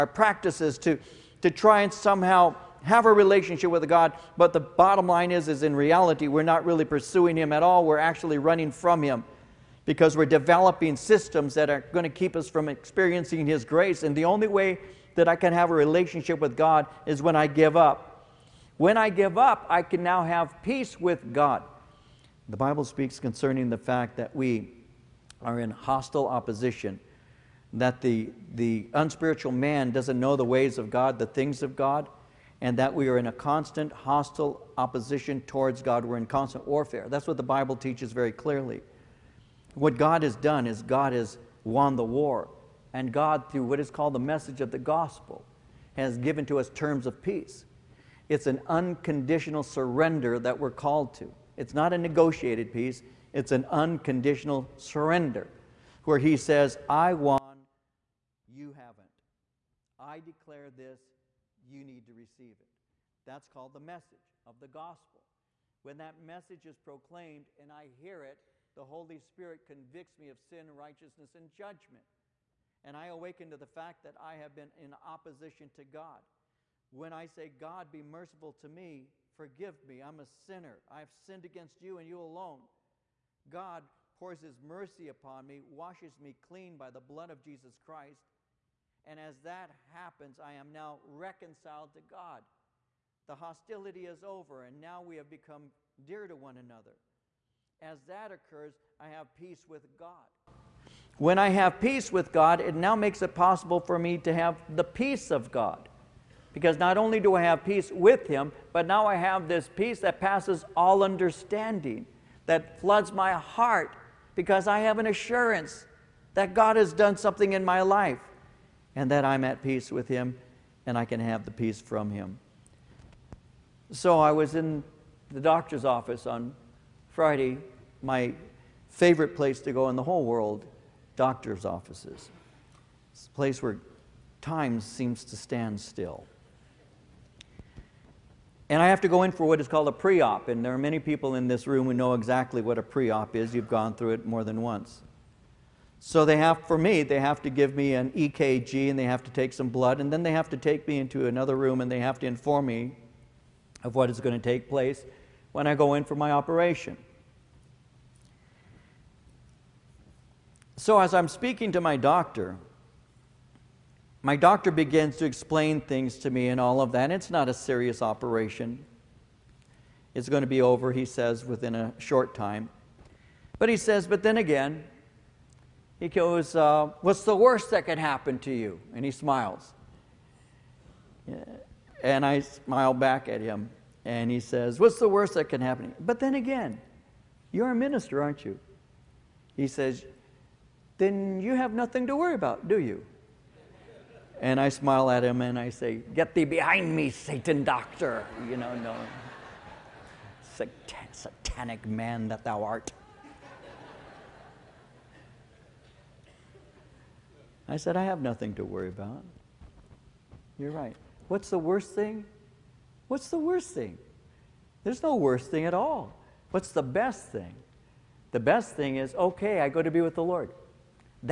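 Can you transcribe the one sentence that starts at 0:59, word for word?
I declare this, you need to receive it.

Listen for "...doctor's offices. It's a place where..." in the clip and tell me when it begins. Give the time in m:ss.
2:11.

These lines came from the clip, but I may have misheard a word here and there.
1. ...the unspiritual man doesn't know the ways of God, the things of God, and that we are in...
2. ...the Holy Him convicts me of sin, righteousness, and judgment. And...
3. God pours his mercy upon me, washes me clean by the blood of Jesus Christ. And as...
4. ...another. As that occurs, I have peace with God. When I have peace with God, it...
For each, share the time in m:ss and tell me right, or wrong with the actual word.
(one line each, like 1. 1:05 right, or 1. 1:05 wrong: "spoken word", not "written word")
1. 0:28 right
2. 1:08 wrong: "Spirit", not "Him"
3. 1:23 right
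4. 1:36 right.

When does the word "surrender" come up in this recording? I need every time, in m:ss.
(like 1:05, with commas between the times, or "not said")
0:49, 0:54.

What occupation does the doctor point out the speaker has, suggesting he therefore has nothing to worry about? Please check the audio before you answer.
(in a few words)
minister.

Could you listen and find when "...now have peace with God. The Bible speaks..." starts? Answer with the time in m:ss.
0:20.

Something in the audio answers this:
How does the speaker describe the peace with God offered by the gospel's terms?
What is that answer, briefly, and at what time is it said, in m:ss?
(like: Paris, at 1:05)
negotiated peace, at 0:51.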